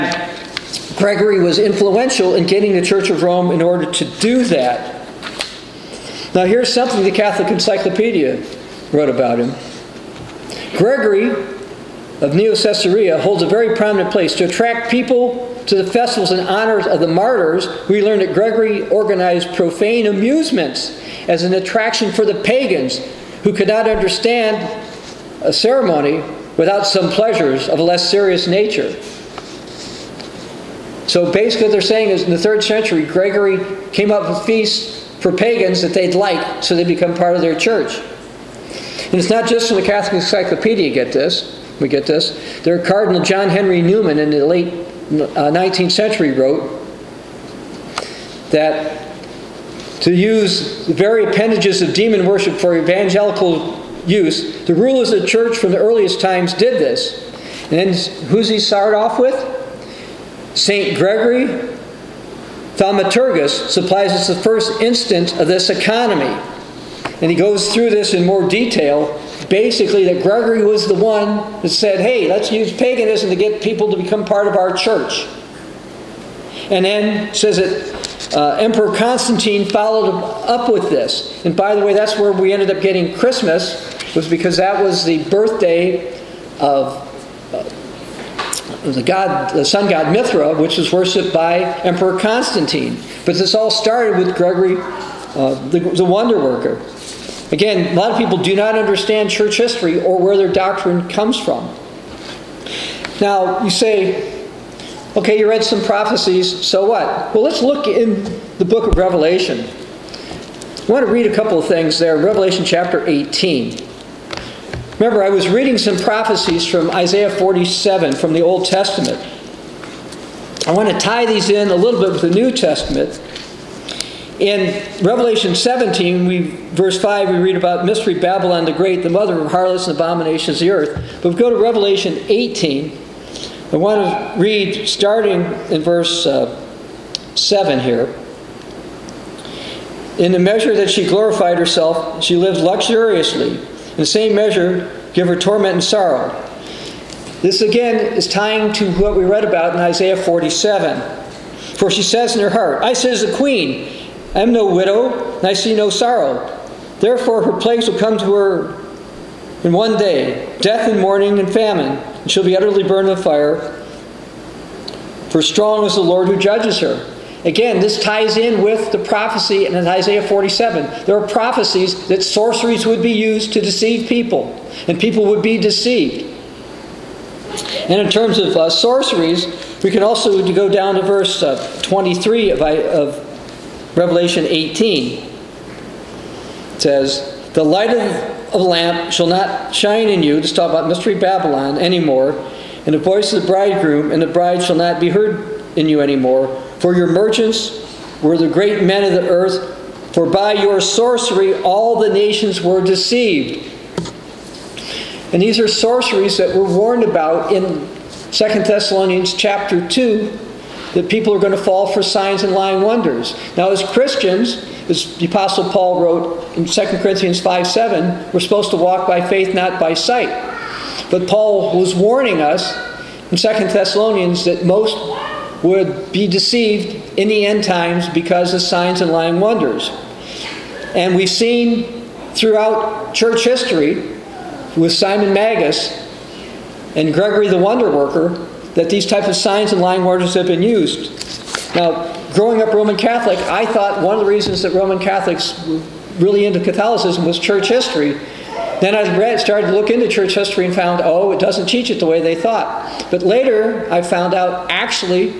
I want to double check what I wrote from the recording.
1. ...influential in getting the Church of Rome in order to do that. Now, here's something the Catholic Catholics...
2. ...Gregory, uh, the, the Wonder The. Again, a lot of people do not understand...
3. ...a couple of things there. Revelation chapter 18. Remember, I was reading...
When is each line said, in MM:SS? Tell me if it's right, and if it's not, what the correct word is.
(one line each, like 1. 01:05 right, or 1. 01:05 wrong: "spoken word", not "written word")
1. 00:01 wrong: "Encyclopedia", not "Catholics"
2. 01:34 wrong: "Worker", not "The"
3. 01:51 right.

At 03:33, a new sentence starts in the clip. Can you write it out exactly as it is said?
Now, as Christians, as the Apostle Paul wrote in 2 Corinthians 5 7, we're supposed to walk by faith, not by sight.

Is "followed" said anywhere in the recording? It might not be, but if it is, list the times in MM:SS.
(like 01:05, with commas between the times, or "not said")
01:19.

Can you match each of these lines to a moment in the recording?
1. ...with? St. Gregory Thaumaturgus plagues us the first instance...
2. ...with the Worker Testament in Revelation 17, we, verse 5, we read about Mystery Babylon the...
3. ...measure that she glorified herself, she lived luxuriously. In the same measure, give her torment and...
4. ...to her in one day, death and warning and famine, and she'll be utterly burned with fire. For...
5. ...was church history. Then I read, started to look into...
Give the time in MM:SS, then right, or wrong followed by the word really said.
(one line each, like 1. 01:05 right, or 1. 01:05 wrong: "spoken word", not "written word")
1. 00:59 wrong: "supplies", not "plagues"
2. 02:02 wrong: "New", not "Worker"
3. 02:20 right
4. 02:38 wrong: "mourning", not "warning"
5. 04:07 right.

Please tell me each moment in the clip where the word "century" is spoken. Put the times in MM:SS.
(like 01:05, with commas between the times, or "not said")
00:32, 00:45.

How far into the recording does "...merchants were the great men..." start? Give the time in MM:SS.
03:17.